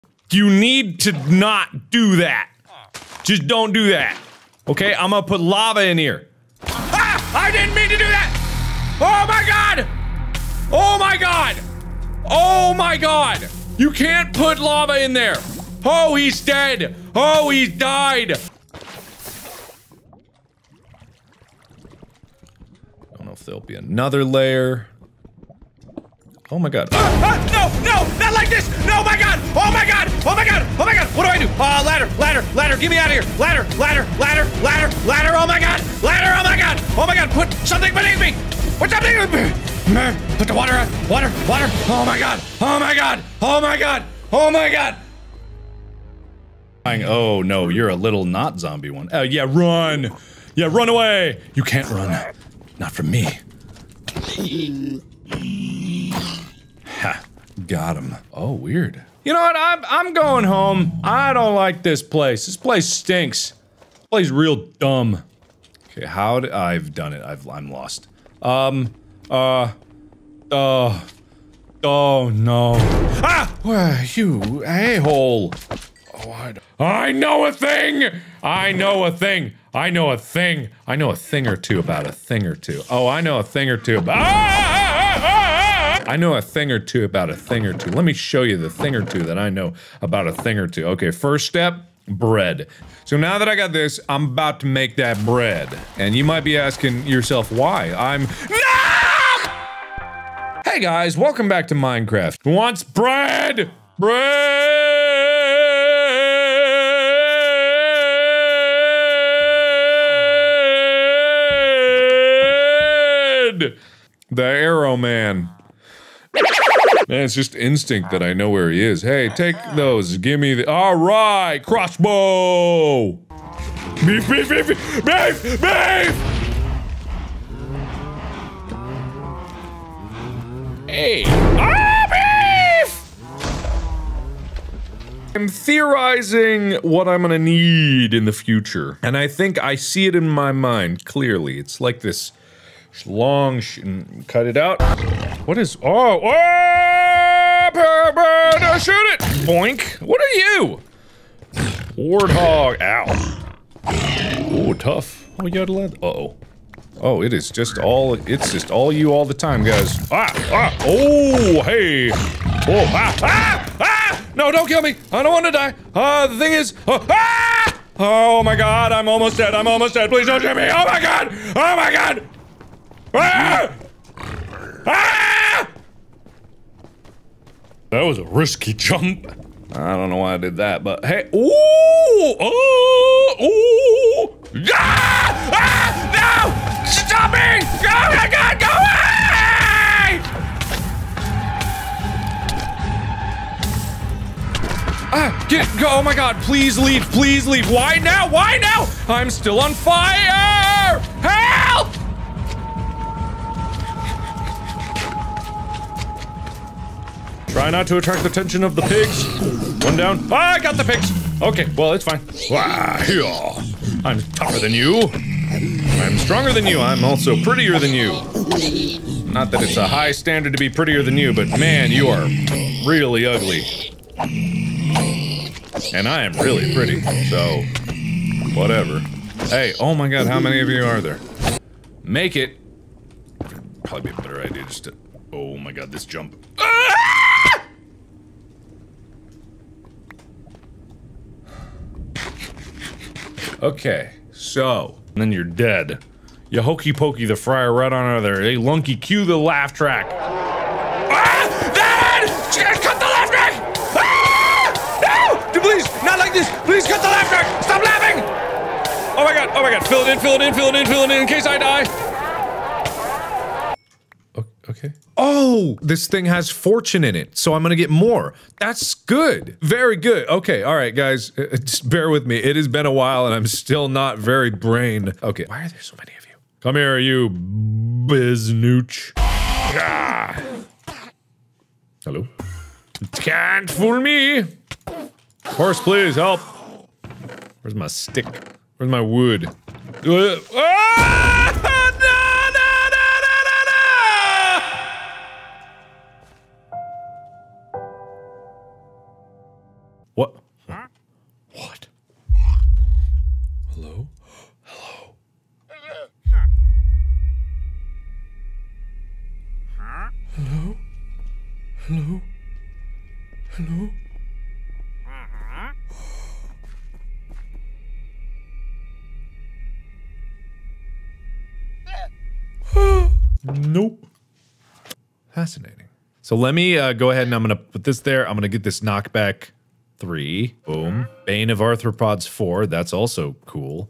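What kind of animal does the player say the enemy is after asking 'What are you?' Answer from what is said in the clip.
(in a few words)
Warthog.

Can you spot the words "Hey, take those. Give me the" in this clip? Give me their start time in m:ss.
1:59.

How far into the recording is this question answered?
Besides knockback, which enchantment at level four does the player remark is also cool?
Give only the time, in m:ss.
5:31.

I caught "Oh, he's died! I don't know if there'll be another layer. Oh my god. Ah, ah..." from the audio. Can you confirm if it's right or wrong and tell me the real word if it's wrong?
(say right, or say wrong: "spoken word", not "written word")
right.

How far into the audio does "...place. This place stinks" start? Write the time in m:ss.
1:02.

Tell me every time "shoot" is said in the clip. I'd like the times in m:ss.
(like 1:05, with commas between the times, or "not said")
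2:28, 2:50.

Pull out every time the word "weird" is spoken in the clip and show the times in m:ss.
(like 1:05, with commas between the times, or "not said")
0:58.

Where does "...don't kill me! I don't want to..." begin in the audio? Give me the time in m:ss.
2:44.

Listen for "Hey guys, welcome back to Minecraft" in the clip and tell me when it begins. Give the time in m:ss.
1:40.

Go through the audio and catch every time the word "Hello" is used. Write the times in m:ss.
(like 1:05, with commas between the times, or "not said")
4:42, 5:13.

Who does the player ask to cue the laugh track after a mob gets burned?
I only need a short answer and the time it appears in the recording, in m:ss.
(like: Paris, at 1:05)
Lunky, at 4:08.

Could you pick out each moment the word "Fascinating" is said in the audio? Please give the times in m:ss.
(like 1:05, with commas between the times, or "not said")
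5:25.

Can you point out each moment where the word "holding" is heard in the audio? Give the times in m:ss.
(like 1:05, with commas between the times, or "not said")
not said.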